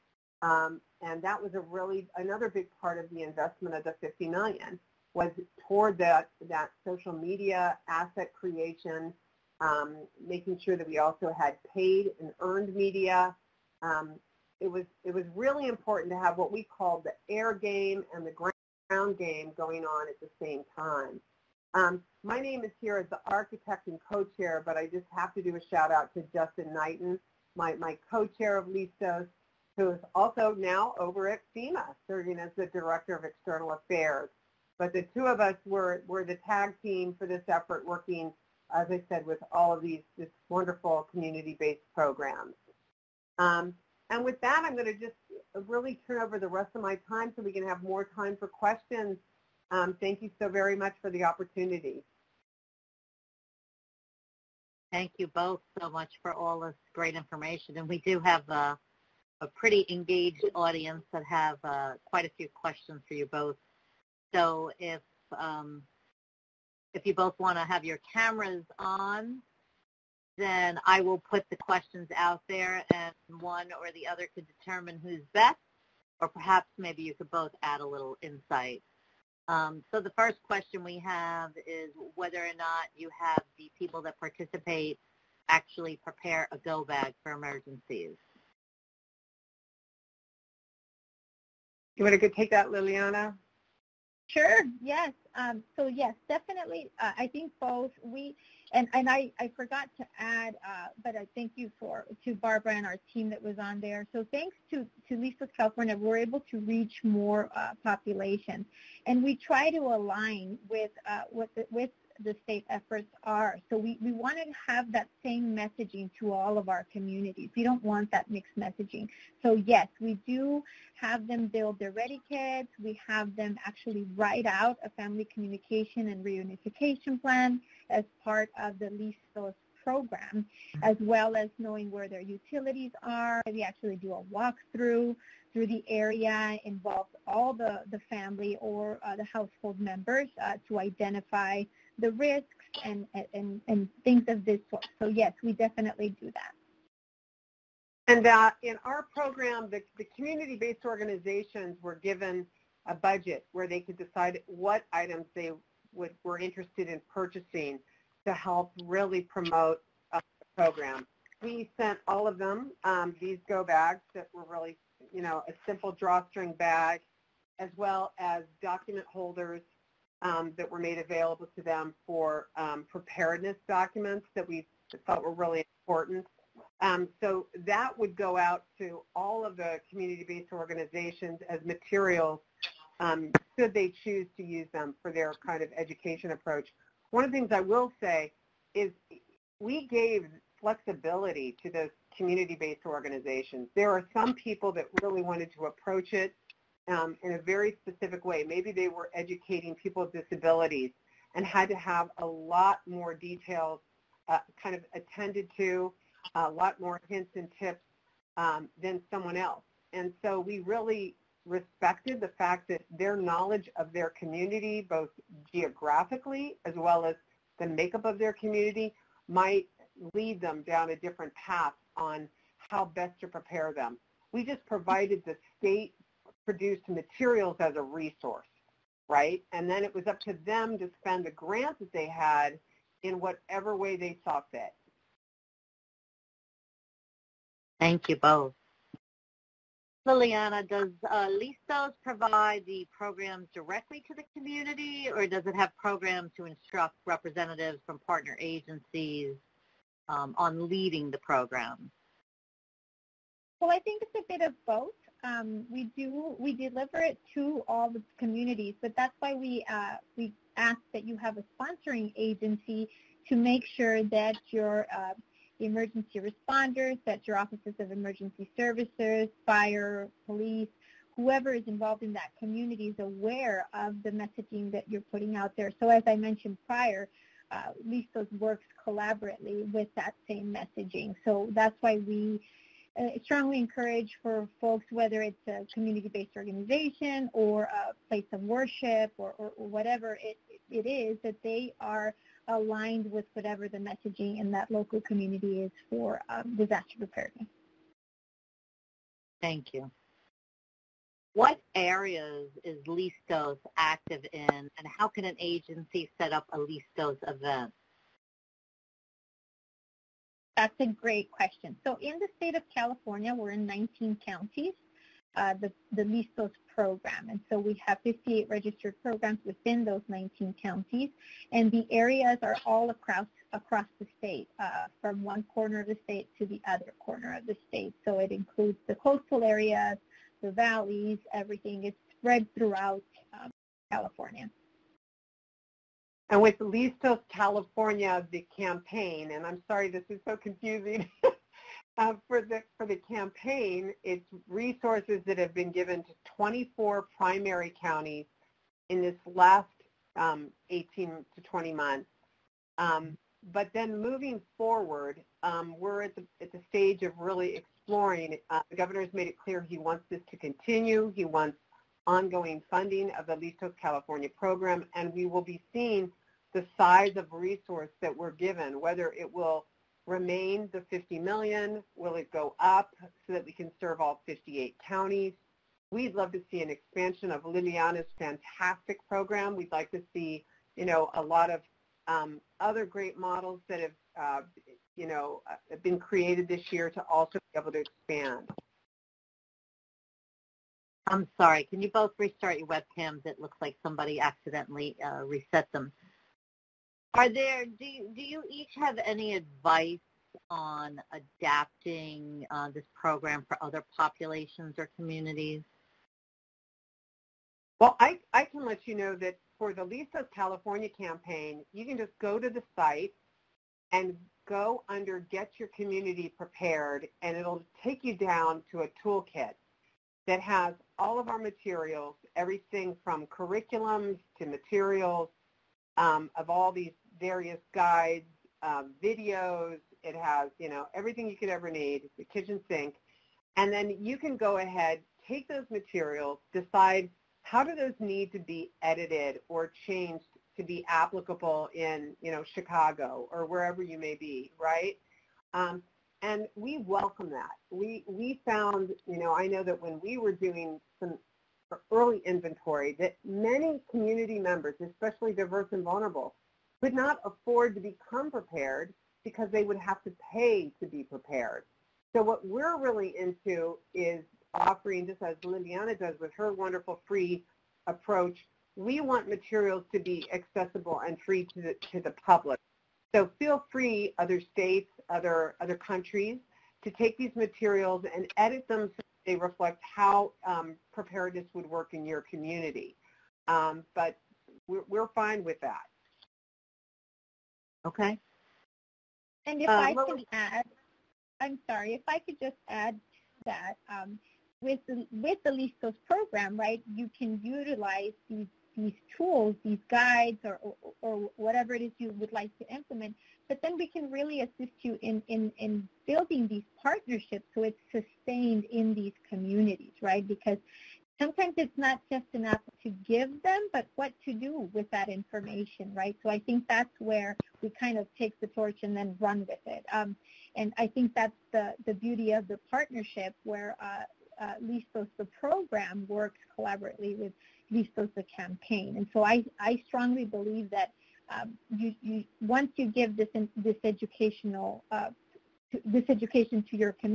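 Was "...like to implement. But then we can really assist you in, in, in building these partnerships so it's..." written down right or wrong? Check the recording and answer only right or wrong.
right.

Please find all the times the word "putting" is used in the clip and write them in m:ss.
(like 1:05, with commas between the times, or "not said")
4:34.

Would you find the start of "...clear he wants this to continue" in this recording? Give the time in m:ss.
5:59.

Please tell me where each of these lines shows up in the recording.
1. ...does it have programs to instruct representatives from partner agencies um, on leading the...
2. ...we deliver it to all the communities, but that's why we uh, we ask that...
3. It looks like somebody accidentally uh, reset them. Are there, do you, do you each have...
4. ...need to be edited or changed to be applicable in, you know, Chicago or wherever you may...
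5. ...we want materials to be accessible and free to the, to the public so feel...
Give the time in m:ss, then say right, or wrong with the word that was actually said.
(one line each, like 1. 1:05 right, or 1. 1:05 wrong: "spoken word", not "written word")
1. 4:05 right
2. 4:16 right
3. 6:33 right
4. 7:17 right
5. 7:48 right.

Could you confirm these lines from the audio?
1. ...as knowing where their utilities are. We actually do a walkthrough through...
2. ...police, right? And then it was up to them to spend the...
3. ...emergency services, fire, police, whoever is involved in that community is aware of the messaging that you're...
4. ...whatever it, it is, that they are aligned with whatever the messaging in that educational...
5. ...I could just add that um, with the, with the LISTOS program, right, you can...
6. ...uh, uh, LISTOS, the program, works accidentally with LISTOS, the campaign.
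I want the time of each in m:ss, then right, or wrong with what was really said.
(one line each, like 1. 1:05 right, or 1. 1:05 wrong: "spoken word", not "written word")
1. 2:11 right
2. 3:47 wrong: "resource", not "police"
3. 4:27 right
4. 4:49 wrong: "local", not "educational"
5. 8:12 right
6. 8:43 wrong: "collaboratively", not "accidentally".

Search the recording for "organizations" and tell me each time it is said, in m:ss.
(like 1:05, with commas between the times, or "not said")
2:30, 3:00, 3:12, 4:46.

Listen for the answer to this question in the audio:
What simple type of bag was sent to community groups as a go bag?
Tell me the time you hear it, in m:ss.
2:45.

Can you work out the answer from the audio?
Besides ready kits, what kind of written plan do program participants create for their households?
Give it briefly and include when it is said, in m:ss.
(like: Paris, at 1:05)
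family communication and reunification plan, at 2:04.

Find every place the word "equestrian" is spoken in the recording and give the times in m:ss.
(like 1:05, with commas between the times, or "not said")
not said.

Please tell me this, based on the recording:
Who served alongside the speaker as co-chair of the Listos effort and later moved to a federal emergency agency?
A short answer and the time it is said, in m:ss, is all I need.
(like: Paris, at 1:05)
Justin Knighton, at 0:26.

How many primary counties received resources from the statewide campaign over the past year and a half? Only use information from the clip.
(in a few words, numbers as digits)
24.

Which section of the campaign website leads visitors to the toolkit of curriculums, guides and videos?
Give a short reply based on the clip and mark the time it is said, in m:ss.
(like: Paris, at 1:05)
Get Your Community Prepared, at 6:55.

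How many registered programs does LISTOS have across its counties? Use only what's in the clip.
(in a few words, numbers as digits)
58.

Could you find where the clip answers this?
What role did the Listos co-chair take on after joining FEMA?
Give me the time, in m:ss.
0:32.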